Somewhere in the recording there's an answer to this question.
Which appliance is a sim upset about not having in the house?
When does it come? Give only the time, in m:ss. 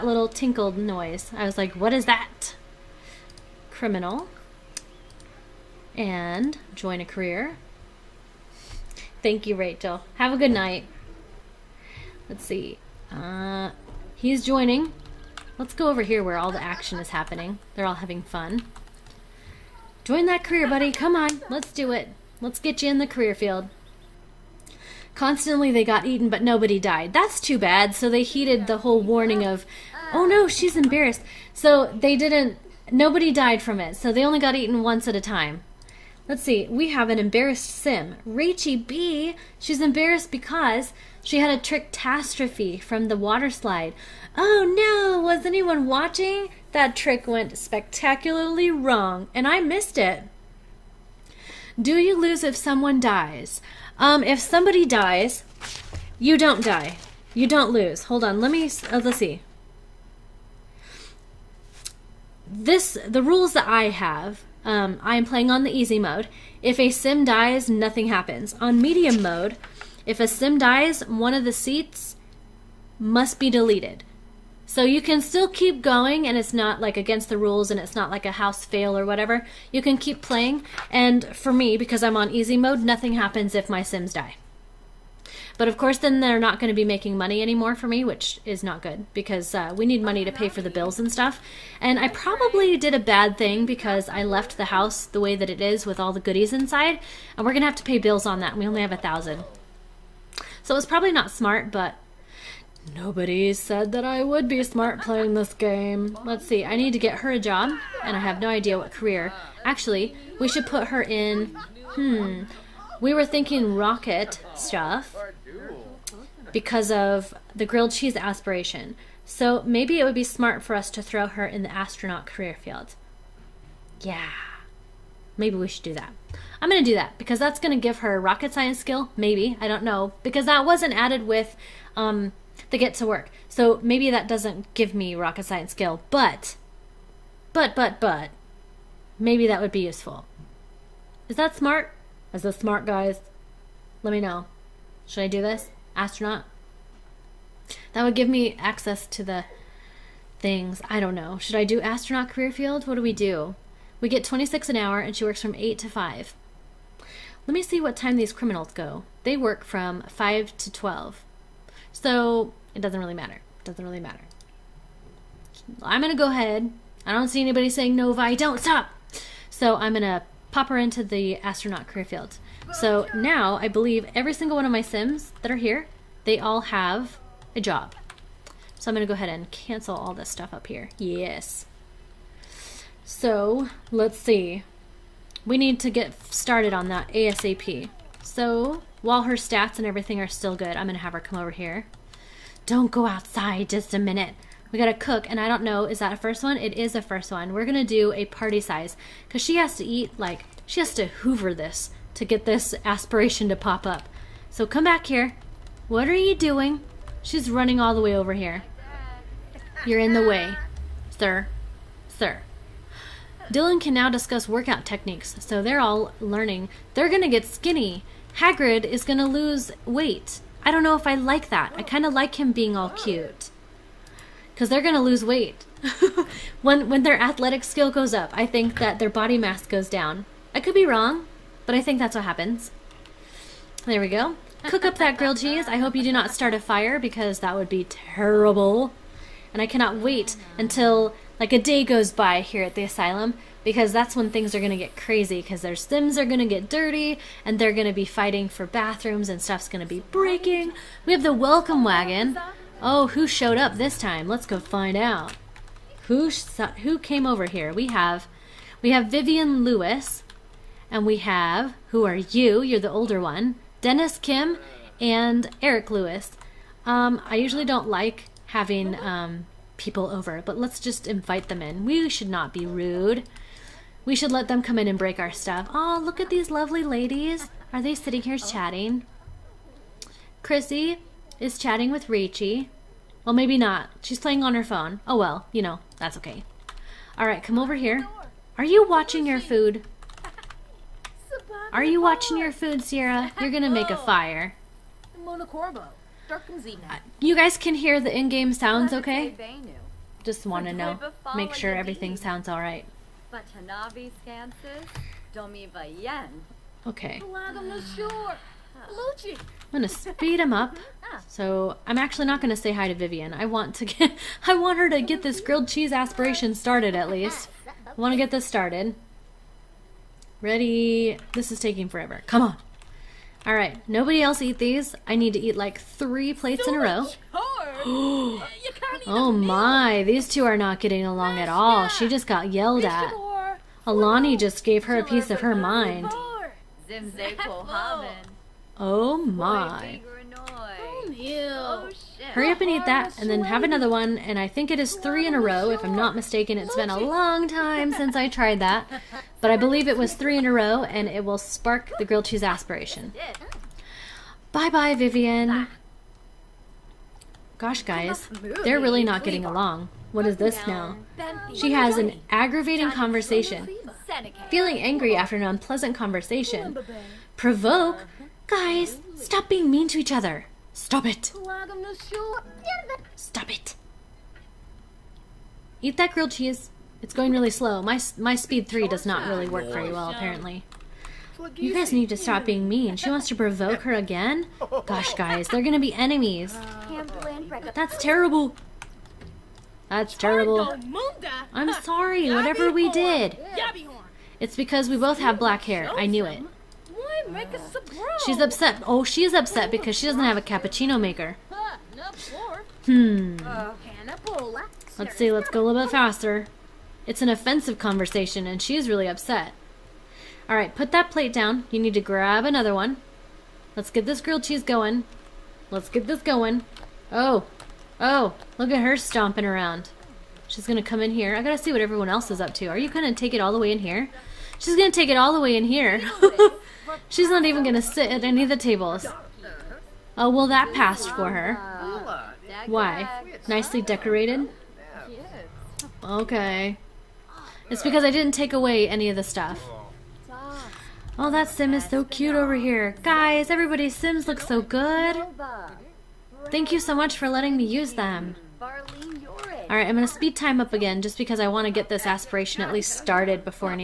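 6:40.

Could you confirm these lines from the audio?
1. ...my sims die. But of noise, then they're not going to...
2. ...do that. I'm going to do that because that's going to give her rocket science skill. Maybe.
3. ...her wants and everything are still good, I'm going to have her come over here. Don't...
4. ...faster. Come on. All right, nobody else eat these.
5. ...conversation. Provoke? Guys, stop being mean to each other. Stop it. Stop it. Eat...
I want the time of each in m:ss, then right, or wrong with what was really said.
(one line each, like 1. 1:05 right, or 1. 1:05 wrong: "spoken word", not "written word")
1. 1:23 wrong: "course", not "noise"
2. 2:05 right
3. 3:09 wrong: "stats", not "wants"
4. 5:21 wrong: "forever", not "faster"
5. 6:05 right.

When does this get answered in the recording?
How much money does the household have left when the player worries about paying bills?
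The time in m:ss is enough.
1:38.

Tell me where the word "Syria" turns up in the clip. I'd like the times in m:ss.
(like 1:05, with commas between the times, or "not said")
not said.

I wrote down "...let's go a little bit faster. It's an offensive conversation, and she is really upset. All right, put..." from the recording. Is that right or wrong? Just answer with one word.
right.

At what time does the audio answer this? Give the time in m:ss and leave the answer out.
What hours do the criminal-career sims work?
2:40.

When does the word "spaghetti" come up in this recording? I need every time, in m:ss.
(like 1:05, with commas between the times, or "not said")
not said.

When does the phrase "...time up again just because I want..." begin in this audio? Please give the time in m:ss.
7:30.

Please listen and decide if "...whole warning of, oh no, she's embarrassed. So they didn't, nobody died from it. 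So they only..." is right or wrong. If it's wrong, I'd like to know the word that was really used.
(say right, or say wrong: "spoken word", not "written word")
right.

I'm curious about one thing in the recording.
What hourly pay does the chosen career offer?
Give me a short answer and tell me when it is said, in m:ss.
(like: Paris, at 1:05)
26, at 2:34.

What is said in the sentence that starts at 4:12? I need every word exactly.
Oh, who showed up this time?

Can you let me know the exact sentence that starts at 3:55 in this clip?
I hope you do not start a fire because that would be terrible.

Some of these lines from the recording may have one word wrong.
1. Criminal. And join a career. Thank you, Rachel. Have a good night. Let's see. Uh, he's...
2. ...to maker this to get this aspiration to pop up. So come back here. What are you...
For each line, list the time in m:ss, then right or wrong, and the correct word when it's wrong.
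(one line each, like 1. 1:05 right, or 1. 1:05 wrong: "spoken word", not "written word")
1. 0:03 right
2. 3:20 wrong: "hoover", not "maker".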